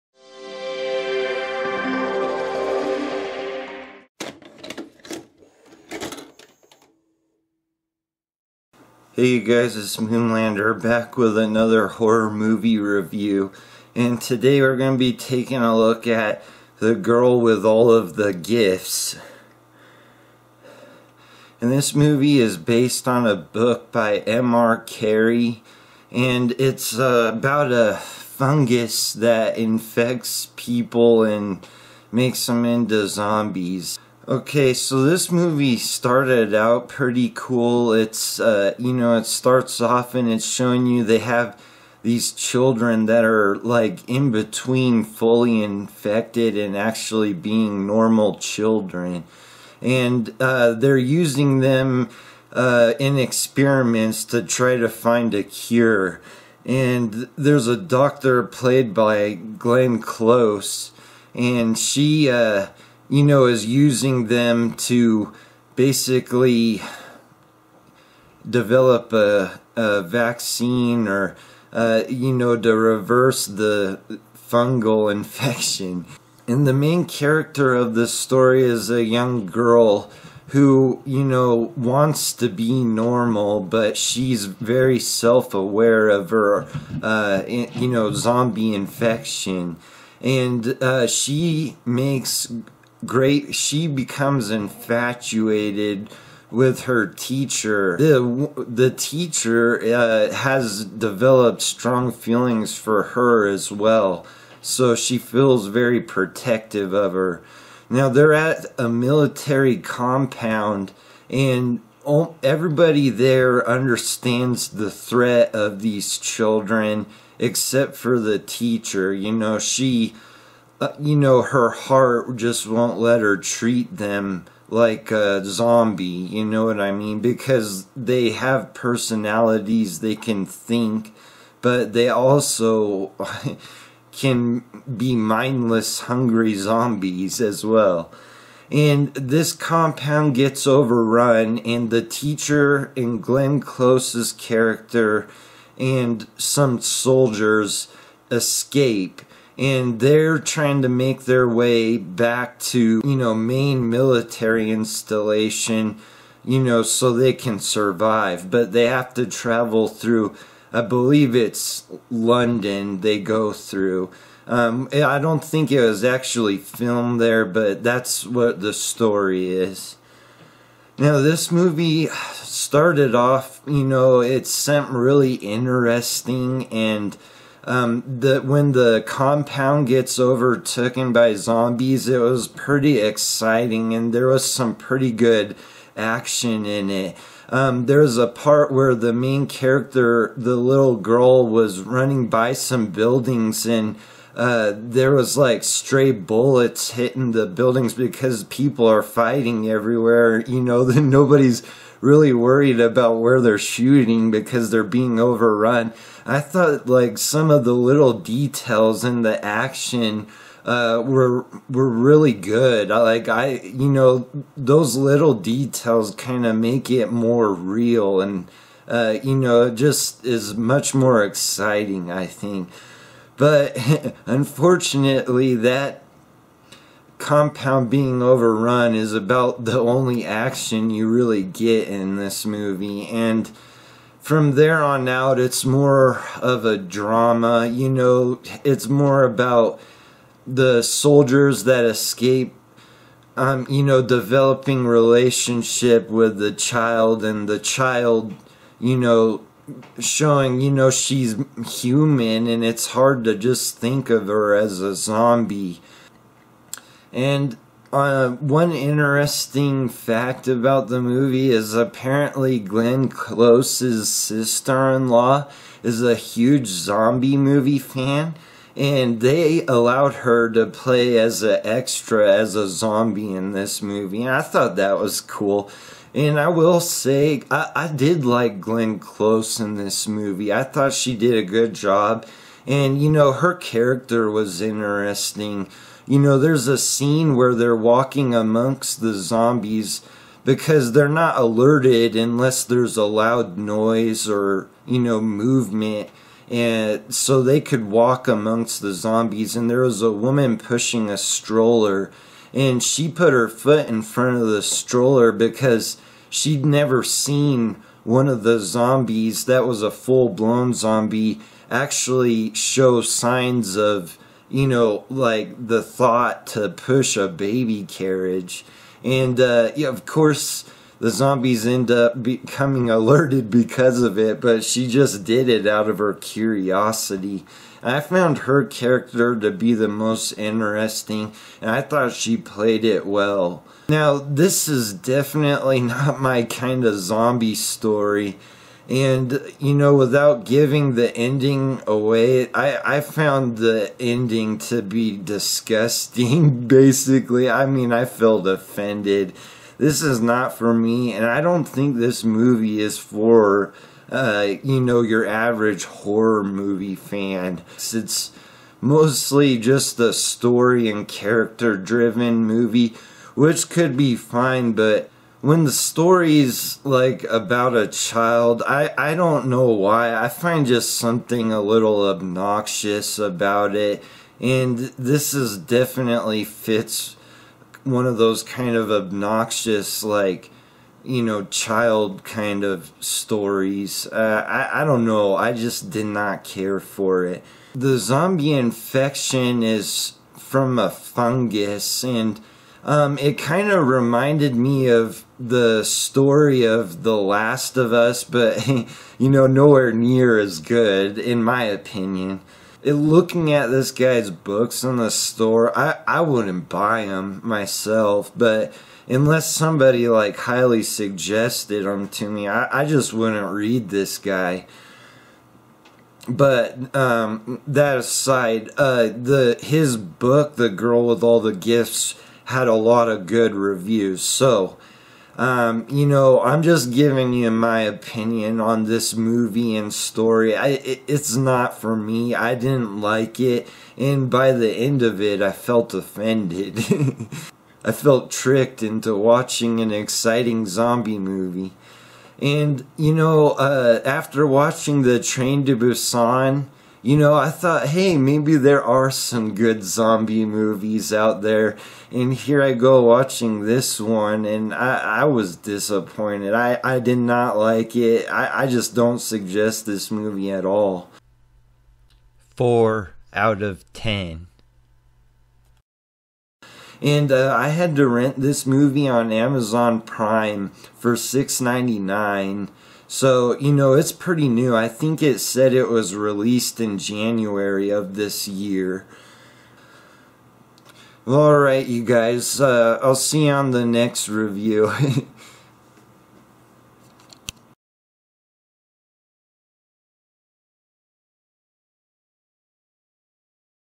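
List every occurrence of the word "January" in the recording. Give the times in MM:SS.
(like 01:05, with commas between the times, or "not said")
07:56.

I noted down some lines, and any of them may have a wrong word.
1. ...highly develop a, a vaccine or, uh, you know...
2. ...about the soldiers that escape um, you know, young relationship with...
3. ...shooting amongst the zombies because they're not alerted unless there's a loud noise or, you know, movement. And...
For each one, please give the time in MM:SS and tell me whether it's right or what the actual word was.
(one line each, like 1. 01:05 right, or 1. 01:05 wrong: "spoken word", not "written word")
1. 01:05 wrong: "basically", not "highly"
2. 03:59 wrong: "developing", not "young"
3. 04:47 wrong: "walking", not "shooting".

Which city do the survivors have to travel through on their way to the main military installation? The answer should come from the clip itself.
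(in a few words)
London.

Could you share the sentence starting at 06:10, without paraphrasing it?
I find just something a little obnoxious about it.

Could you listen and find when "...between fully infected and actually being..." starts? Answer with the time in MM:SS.
00:44.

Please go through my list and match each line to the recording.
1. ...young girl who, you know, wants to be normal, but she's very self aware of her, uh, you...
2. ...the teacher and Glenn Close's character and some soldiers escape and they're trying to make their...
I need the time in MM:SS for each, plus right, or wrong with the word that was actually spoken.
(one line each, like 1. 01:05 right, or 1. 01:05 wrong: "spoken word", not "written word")
1. 01:19 right
2. 02:21 right.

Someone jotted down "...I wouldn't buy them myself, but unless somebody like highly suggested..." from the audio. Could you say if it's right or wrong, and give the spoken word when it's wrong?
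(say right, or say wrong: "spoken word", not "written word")
right.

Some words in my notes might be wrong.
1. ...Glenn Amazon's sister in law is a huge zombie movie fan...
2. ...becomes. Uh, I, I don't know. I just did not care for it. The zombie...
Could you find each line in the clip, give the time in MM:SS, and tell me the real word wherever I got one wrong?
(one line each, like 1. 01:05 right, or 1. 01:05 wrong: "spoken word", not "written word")
1. 04:22 wrong: "Close", not "Amazon"
2. 06:22 wrong: "stories", not "becomes".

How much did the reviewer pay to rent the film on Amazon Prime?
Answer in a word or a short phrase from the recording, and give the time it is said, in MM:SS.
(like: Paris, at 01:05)
$6.99, at 07:51.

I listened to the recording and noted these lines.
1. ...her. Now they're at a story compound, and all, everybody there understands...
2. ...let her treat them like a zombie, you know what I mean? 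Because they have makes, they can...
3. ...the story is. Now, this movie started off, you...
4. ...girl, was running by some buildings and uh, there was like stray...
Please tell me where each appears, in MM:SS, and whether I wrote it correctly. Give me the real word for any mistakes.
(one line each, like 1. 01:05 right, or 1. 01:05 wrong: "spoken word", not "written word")
1. 01:47 wrong: "military", not "story"
2. 02:02 wrong: "personalities", not "makes"
3. 02:48 right
4. 03:10 right.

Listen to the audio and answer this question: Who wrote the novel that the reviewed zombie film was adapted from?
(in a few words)
M.R. Carey.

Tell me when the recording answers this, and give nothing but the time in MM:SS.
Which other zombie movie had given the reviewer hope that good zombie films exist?
07:25.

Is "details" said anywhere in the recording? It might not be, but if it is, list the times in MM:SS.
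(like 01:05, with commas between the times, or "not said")
03:28, 03:35.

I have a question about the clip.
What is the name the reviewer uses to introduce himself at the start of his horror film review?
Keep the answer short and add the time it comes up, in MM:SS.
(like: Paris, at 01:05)
Moonlander, at 00:09.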